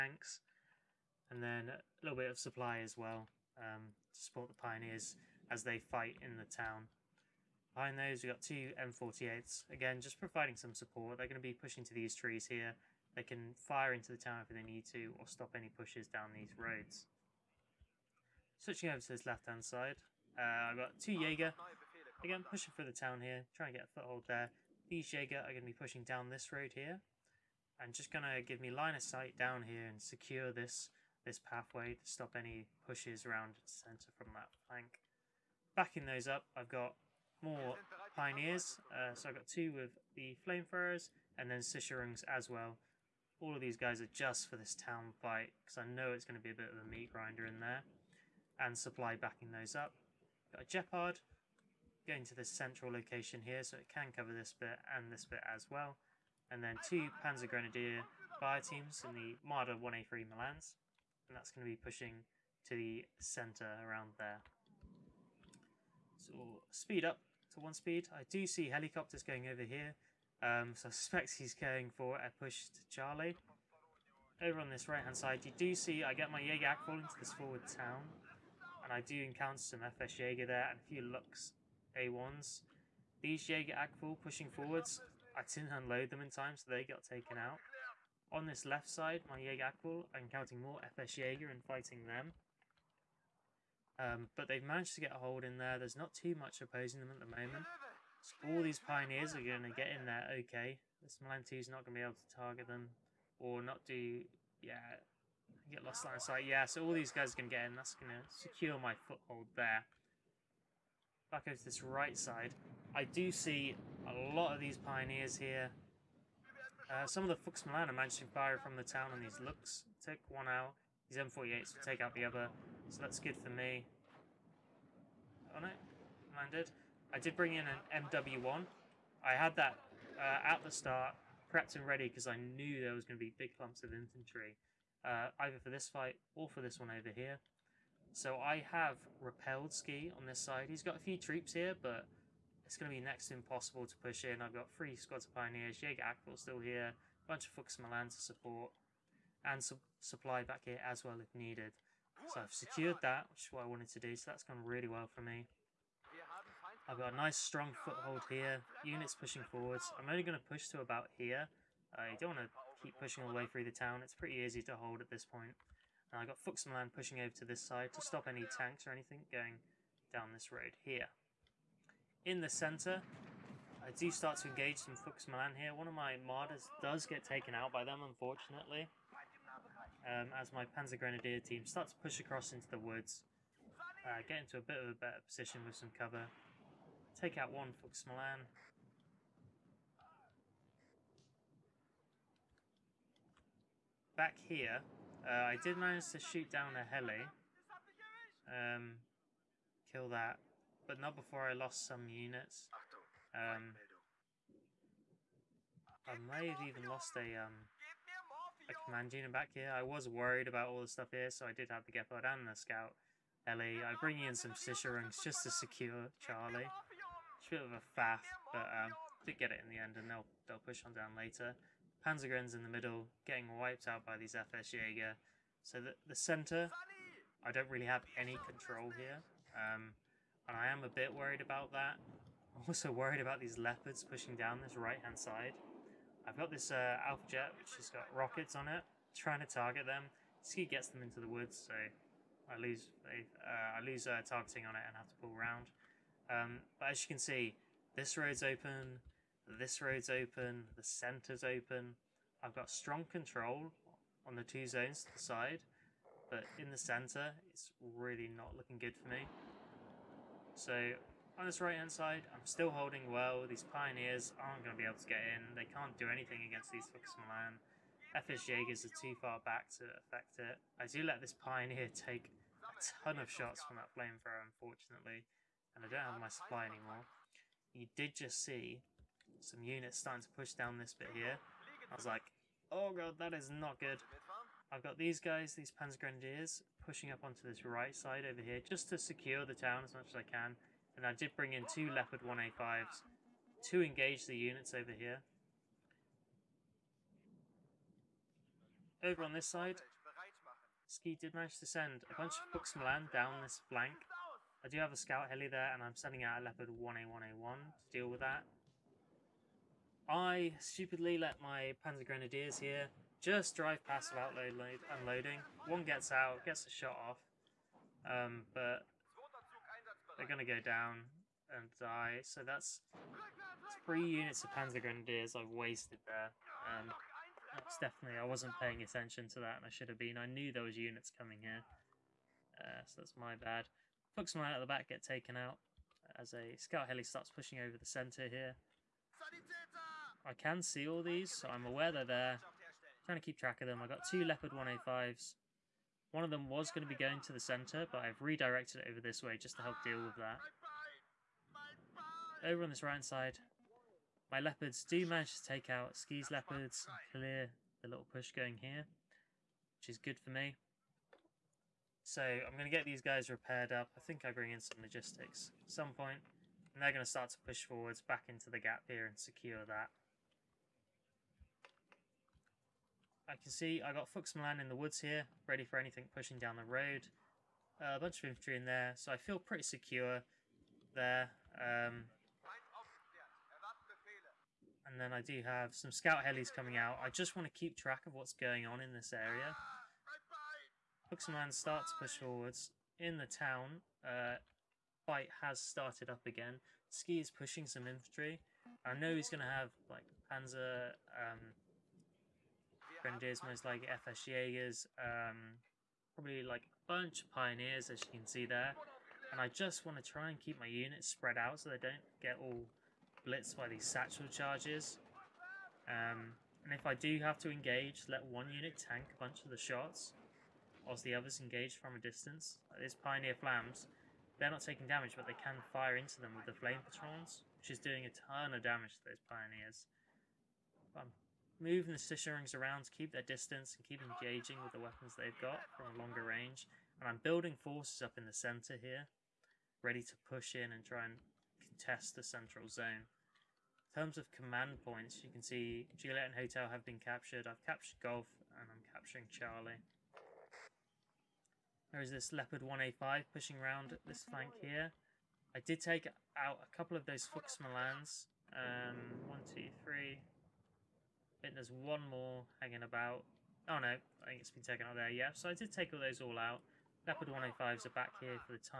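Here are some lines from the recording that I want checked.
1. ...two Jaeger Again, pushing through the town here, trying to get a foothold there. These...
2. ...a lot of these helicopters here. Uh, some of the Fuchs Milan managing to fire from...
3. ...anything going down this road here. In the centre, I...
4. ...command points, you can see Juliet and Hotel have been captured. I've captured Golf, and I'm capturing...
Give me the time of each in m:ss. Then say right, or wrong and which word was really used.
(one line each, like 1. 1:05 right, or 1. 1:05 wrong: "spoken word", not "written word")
1. 0:20 right
2. 1:54 wrong: "pioneers", not "helicopters"
3. 2:48 right
4. 7:24 right.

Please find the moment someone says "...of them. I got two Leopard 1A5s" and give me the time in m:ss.
5:43.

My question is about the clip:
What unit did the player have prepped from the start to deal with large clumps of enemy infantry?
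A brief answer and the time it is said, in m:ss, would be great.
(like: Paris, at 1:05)
MW1, at 2:07.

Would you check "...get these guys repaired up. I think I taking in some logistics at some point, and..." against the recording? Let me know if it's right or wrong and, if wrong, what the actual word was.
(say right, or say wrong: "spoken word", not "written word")
wrong: "bring", not "taking".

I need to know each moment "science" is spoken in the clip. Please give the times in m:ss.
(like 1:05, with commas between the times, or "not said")
not said.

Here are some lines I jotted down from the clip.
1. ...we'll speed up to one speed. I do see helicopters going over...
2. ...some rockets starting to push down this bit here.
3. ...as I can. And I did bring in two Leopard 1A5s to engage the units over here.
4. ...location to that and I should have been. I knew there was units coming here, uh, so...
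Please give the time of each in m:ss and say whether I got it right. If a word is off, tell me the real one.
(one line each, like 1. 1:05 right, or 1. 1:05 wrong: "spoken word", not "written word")
1. 1:06 right
2. 4:39 wrong: "units", not "rockets"
3. 4:50 right
4. 5:28 wrong: "attention", not "location".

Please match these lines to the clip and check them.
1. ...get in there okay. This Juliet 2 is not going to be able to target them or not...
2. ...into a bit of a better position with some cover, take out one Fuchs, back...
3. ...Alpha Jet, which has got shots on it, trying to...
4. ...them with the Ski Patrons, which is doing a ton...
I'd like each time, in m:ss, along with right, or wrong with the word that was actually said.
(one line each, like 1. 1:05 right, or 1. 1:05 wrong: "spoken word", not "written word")
1. 1:39 wrong: "Milan", not "Juliet"
2. 3:04 wrong: "Fuxman", not "Fuchs"
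3. 3:57 wrong: "rockets", not "shots"
4. 7:06 wrong: "Flame", not "Ski".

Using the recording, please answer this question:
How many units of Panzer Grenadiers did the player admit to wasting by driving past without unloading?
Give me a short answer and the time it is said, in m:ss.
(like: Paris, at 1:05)
3, at 5:23.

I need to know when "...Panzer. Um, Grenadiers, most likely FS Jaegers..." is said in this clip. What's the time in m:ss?
6:40.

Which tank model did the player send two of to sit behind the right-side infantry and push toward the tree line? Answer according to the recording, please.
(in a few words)
M48.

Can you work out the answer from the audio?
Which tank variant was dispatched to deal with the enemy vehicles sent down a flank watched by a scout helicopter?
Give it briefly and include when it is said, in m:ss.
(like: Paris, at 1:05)
Leopard 1A1A1, at 5:06.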